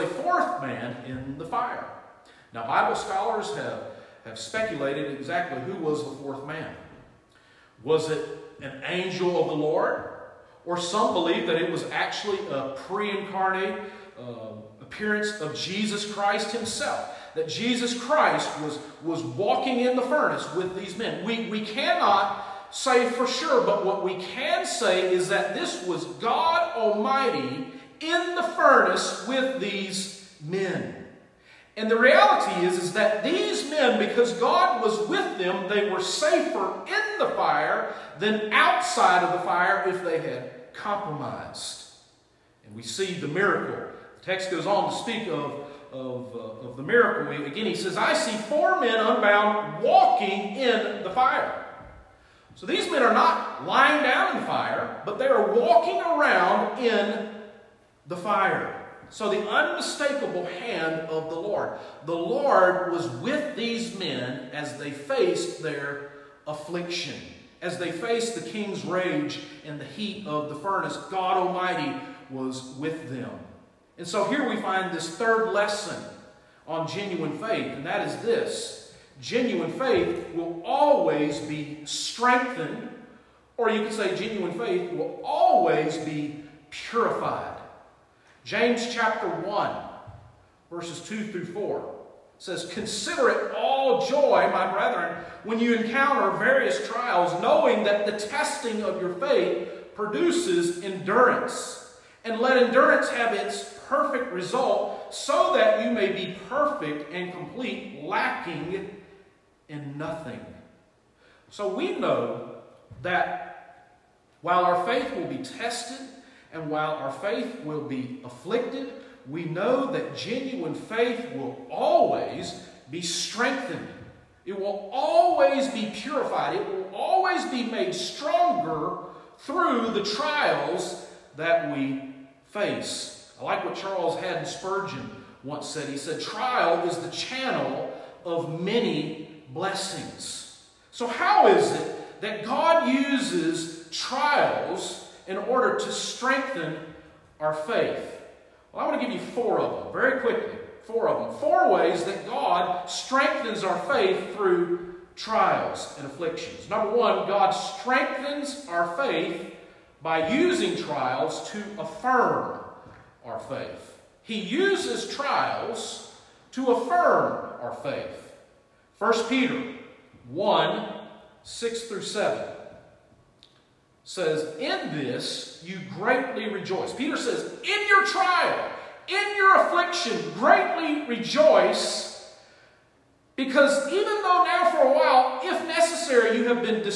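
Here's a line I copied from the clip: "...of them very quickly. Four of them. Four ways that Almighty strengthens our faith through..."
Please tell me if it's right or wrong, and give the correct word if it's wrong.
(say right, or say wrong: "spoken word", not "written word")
wrong: "God", not "Almighty".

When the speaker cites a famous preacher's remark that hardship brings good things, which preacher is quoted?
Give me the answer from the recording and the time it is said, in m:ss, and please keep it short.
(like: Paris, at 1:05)
Charles Haddon Spurgeon, at 2:13.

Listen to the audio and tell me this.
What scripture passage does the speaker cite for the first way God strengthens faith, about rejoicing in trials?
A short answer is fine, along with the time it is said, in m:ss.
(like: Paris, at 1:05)
1 Peter 1:6-7, at 2:48.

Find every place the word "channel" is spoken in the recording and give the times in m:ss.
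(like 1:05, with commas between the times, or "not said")
2:17.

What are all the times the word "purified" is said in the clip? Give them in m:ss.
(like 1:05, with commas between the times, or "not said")
1:26, 2:05.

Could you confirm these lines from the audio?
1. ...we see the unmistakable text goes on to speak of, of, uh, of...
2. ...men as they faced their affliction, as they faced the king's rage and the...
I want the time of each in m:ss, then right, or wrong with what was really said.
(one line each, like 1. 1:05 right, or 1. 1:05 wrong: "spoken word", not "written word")
1. 0:42 wrong: "miracle", not "unmistakable"
2. 1:03 right.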